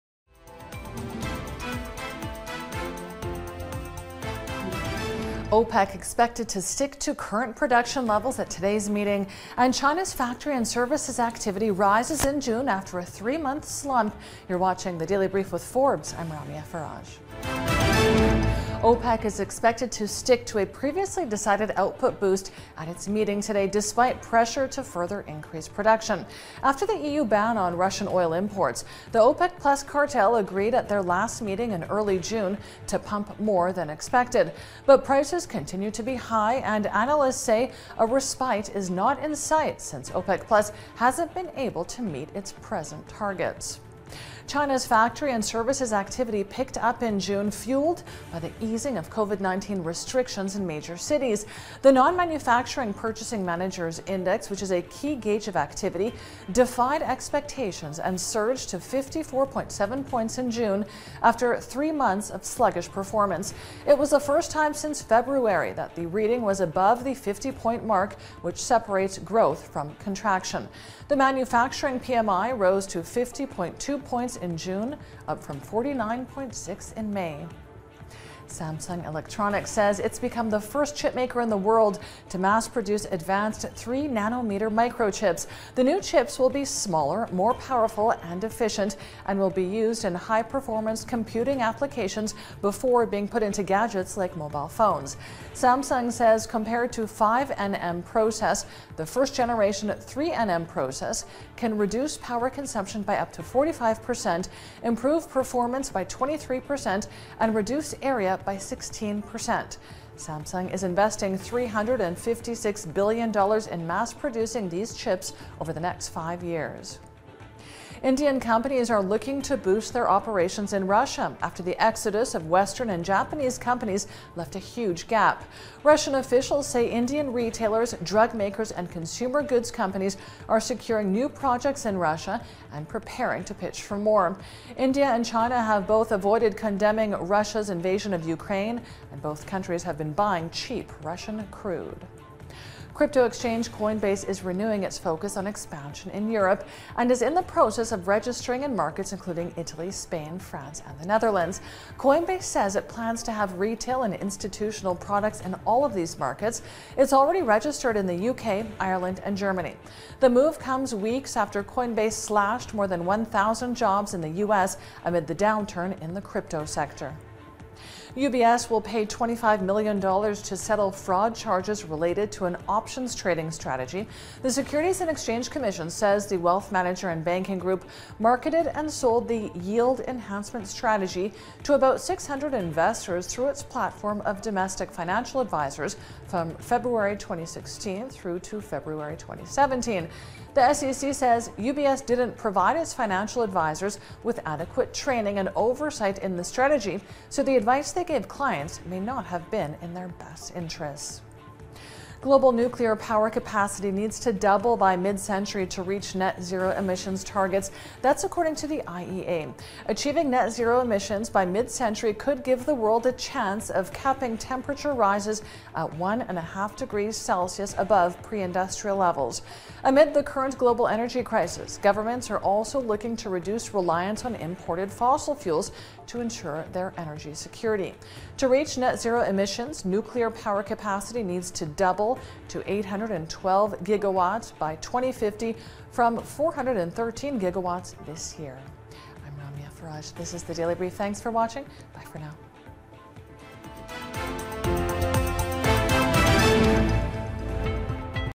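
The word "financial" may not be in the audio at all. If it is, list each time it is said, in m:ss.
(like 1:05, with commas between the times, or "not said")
3:04, 3:12.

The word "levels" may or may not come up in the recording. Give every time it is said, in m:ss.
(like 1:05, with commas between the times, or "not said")
0:08, 3:38.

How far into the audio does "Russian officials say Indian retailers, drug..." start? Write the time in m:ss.
2:05.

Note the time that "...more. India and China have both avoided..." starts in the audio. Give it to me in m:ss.
2:13.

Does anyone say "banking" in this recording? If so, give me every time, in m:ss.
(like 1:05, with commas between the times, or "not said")
2:57.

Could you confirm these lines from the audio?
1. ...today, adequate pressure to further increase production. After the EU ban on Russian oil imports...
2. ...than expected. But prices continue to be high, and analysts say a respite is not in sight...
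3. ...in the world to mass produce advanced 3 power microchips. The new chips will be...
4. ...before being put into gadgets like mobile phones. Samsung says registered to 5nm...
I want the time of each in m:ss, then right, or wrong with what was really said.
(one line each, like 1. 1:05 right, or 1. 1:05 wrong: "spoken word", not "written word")
1. 0:23 wrong: "despite", not "adequate"
2. 0:33 right
3. 1:21 wrong: "nanometer", not "power"
4. 1:32 wrong: "compared", not "registered".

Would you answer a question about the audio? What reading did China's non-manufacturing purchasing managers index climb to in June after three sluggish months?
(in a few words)
54.7.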